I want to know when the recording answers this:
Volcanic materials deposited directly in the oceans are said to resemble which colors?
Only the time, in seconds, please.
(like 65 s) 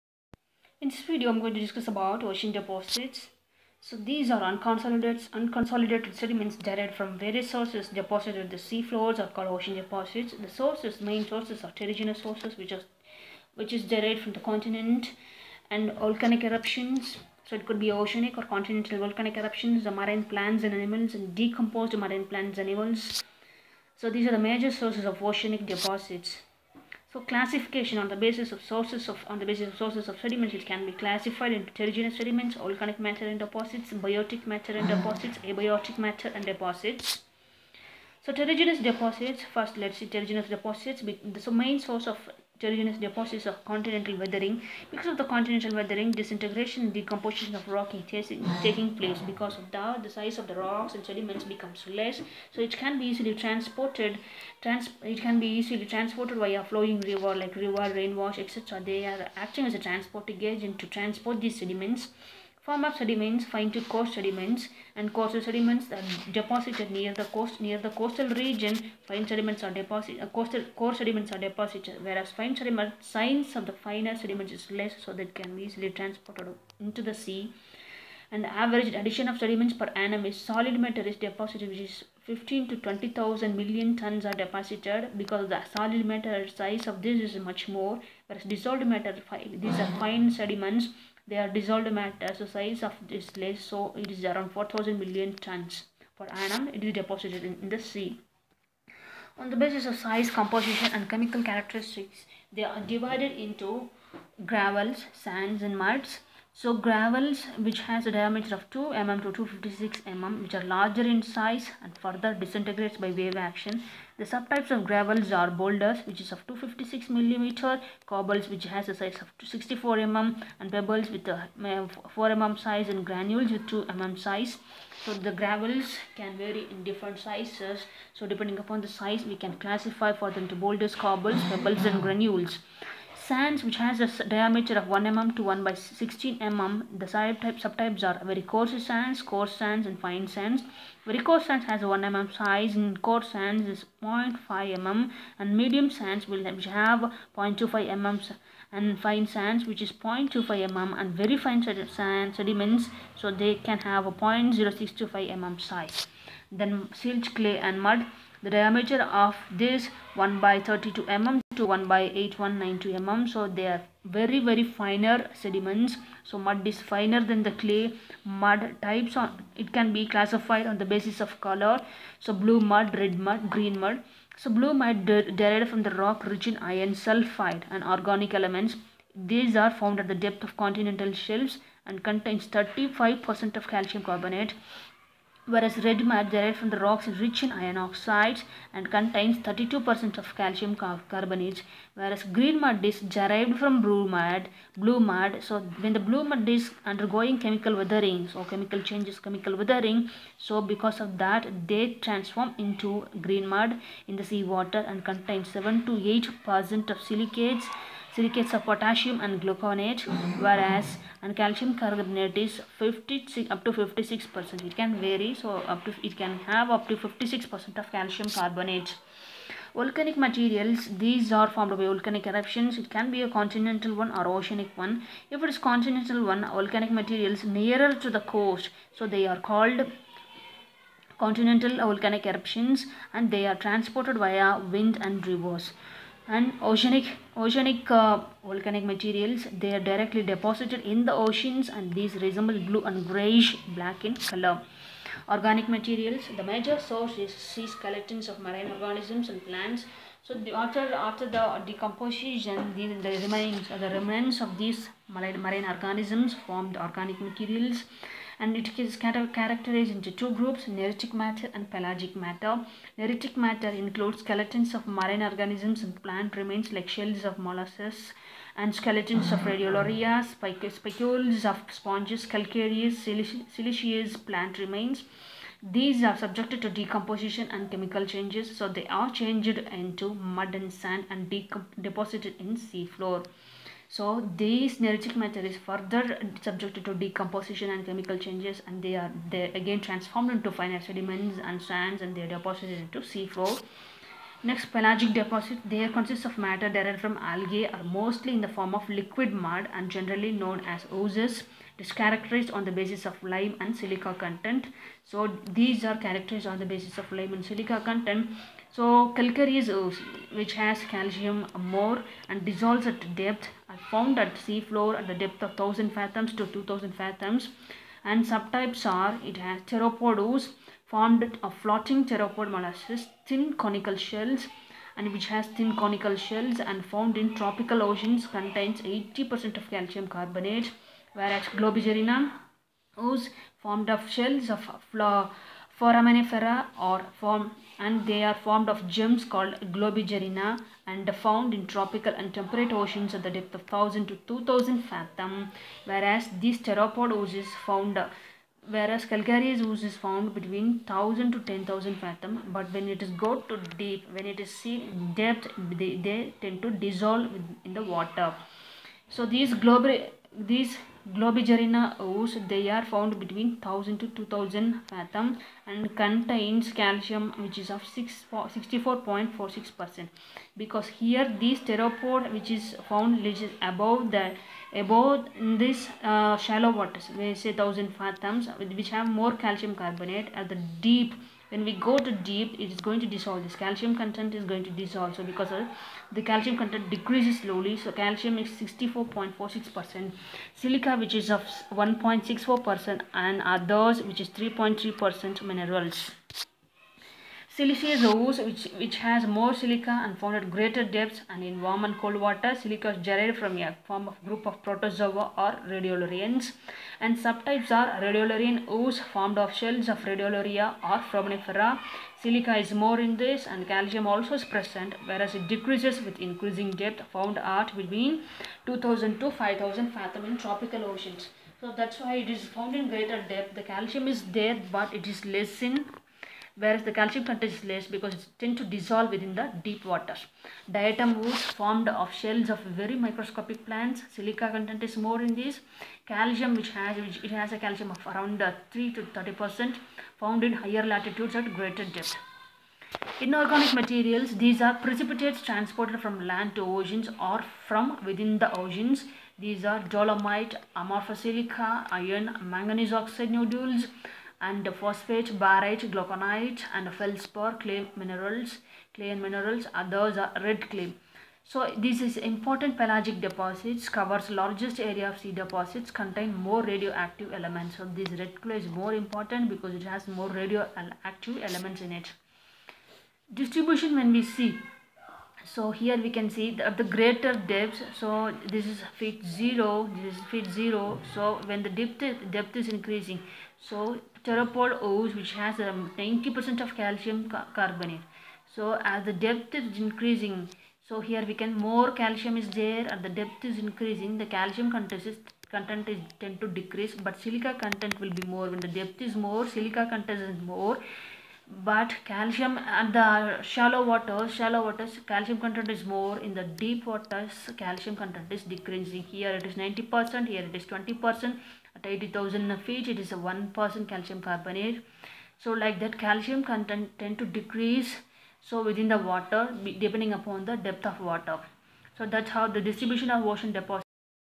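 242 s.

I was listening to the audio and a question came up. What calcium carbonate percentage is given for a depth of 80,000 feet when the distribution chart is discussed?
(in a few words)
1%.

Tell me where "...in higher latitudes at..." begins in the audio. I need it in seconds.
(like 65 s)
440 s.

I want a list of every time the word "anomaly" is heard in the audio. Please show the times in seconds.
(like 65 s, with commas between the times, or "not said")
not said.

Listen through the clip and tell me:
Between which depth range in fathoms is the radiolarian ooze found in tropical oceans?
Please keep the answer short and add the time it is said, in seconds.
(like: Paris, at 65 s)
2000 to 5000 fathoms, at 418 s.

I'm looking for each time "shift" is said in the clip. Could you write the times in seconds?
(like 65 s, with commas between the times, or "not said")
not said.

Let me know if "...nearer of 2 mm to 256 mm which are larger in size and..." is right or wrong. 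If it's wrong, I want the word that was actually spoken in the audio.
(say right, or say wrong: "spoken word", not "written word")
wrong: "diameter", not "nearer".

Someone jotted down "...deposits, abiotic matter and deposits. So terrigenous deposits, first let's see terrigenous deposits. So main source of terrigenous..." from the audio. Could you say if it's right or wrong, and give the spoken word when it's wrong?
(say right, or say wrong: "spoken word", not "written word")
right.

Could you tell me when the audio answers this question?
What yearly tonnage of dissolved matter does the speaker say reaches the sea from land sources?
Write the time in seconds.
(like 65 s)
94 s.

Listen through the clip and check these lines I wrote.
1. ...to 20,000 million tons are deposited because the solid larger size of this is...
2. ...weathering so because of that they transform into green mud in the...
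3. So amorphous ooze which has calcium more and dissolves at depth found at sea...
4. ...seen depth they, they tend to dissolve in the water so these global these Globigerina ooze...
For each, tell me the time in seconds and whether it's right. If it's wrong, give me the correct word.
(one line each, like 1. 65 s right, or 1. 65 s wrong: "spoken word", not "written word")
1. 82 s wrong: "matter", not "larger"
2. 199 s right
3. 308 s wrong: "calcareous", not "amorphous"
4. 354 s right.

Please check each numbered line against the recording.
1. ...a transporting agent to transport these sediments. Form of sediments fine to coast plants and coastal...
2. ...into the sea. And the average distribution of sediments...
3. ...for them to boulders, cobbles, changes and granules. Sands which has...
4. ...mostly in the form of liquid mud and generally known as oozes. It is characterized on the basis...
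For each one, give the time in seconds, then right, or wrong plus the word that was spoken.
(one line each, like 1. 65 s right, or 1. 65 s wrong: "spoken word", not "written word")
1. 59 s wrong: "sediments", not "plants"
2. 76 s wrong: "addition", not "distribution"
3. 130 s wrong: "pebbles", not "changes"
4. 297 s right.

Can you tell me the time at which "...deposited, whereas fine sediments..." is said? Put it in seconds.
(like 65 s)
71 s.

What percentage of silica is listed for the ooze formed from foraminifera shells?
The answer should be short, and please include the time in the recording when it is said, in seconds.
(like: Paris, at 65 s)
1.64%, at 391 s.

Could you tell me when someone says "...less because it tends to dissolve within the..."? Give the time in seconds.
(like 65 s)
427 s.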